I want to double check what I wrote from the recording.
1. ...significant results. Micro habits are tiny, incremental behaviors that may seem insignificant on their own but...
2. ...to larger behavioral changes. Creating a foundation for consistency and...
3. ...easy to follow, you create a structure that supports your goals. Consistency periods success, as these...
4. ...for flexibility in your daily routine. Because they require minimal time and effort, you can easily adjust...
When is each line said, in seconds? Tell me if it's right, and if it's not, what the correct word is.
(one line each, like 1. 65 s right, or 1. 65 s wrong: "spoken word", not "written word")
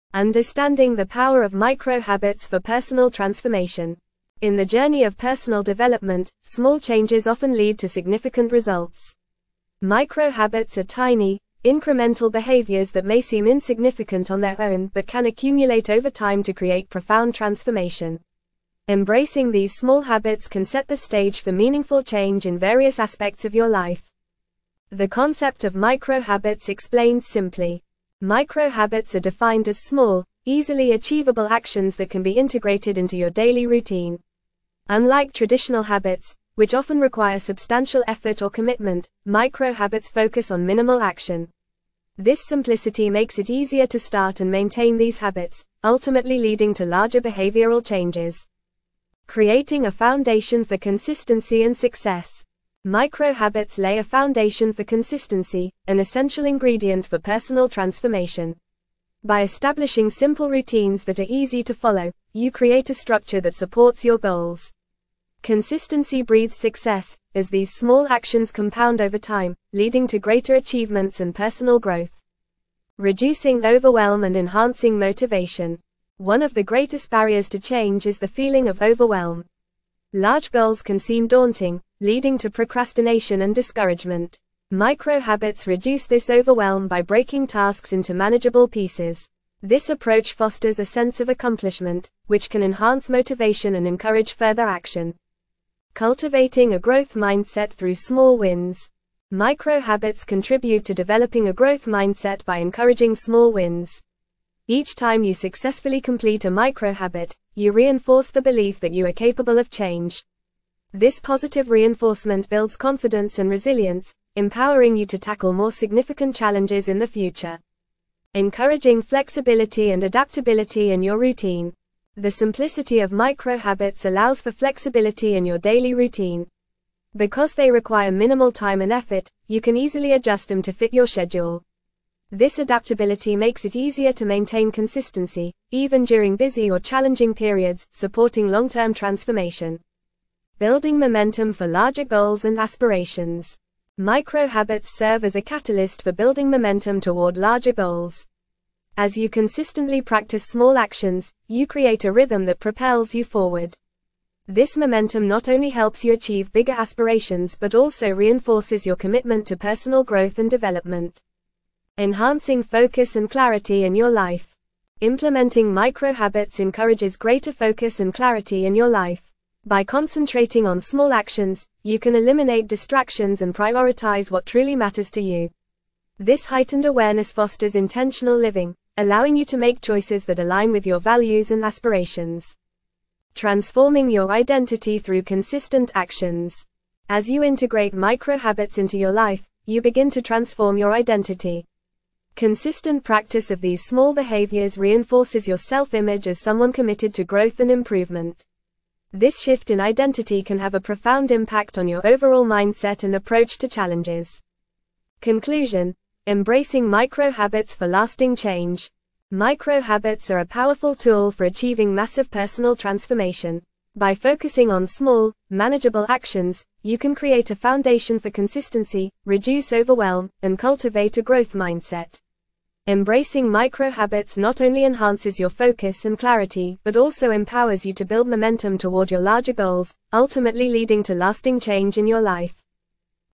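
1. 7 s right
2. 46 s right
3. 61 s wrong: "breeds", not "periods"
4. 124 s right.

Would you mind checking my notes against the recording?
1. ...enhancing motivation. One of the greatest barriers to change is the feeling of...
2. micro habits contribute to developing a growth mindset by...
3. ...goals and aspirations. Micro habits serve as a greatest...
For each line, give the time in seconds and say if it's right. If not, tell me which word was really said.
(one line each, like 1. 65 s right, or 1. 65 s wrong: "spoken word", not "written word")
1. 74 s right
2. 99 s right
3. 142 s wrong: "catalyst", not "greatest".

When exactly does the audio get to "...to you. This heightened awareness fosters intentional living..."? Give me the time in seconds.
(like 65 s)
175 s.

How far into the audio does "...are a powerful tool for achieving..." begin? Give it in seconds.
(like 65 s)
210 s.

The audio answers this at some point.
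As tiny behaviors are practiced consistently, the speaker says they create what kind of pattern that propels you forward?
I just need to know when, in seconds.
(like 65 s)
152 s.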